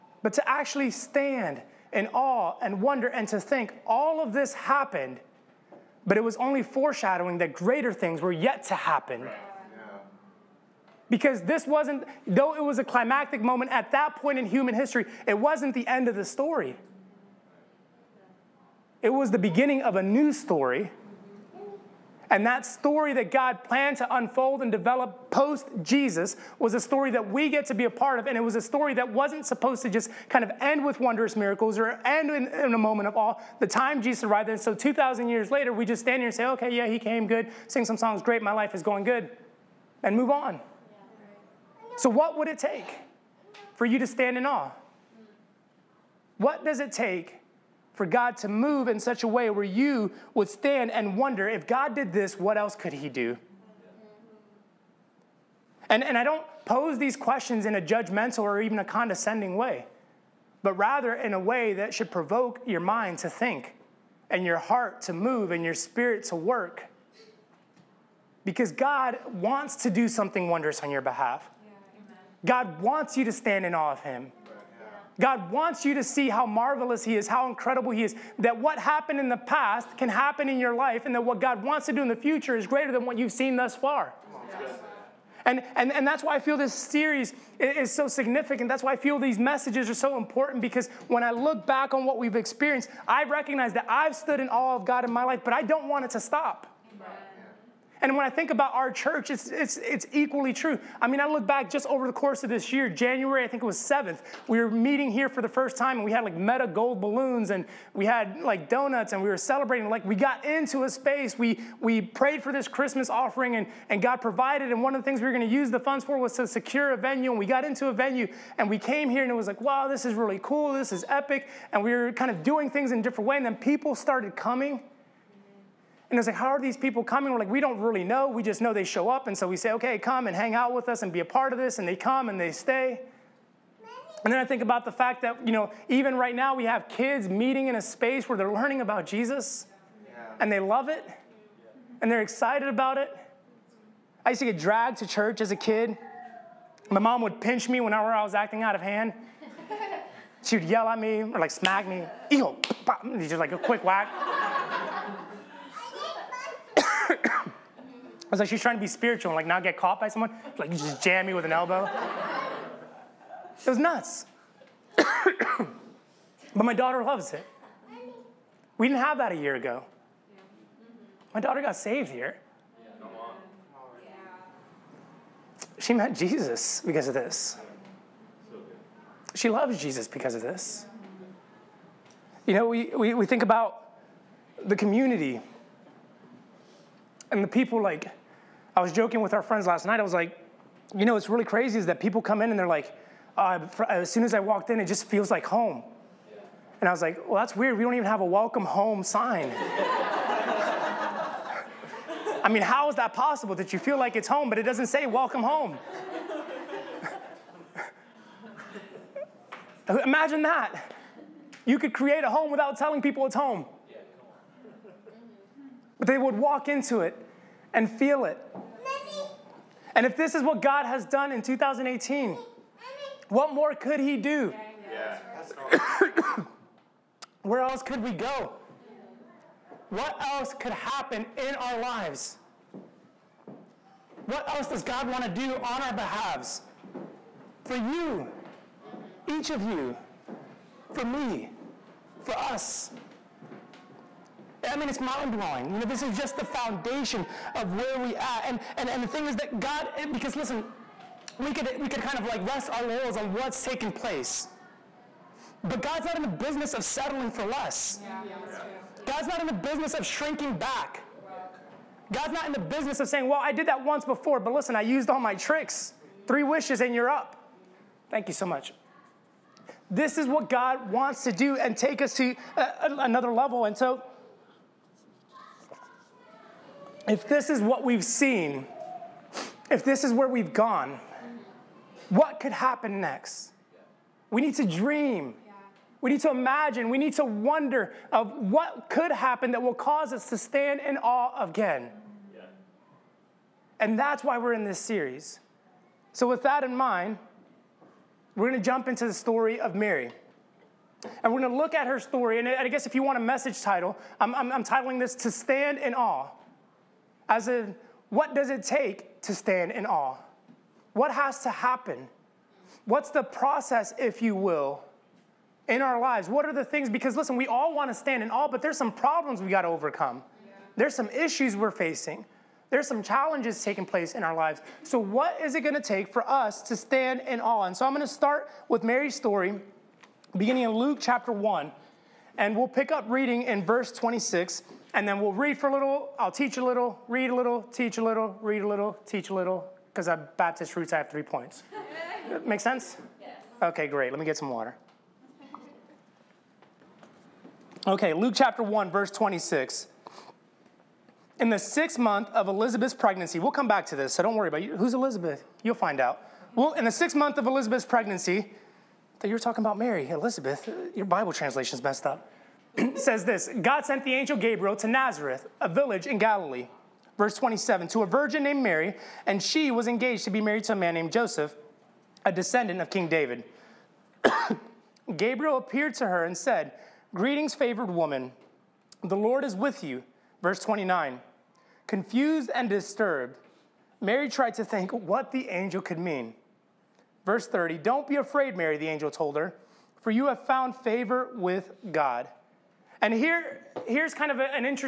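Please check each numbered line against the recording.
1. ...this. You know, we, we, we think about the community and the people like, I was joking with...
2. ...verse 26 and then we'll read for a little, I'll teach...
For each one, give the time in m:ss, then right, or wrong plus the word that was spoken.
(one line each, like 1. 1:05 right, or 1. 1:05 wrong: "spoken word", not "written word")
1. 3:00 right
2. 5:33 right.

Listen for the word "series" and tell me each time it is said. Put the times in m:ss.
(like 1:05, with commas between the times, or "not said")
1:26, 4:54.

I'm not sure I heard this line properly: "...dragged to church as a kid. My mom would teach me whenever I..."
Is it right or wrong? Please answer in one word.
wrong.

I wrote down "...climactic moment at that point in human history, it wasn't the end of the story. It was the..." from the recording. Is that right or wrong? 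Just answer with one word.
right.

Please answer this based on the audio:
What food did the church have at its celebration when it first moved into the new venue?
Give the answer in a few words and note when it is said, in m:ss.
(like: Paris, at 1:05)
donuts, at 1:48.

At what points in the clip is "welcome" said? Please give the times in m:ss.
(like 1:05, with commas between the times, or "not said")
3:18, 3:25.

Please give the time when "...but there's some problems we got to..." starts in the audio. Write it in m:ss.
5:18.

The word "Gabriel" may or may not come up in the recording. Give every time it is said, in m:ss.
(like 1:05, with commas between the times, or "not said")
6:04, 6:15.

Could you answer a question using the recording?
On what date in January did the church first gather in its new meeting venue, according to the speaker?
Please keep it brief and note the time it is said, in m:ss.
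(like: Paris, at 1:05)
7th, at 1:43.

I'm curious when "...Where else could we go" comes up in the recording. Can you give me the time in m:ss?
3:47.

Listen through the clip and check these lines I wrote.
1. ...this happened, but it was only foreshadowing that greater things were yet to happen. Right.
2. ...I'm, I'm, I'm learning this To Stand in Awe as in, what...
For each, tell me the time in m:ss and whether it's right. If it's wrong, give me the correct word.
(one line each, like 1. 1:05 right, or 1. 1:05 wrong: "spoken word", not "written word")
1. 0:04 right
2. 5:04 wrong: "titling", not "learning".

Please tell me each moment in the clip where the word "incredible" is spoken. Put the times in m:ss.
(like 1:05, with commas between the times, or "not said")
1:17.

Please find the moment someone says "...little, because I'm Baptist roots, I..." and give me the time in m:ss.
5:39.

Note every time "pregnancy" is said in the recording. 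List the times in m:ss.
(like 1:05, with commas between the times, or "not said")
5:52, 5:57.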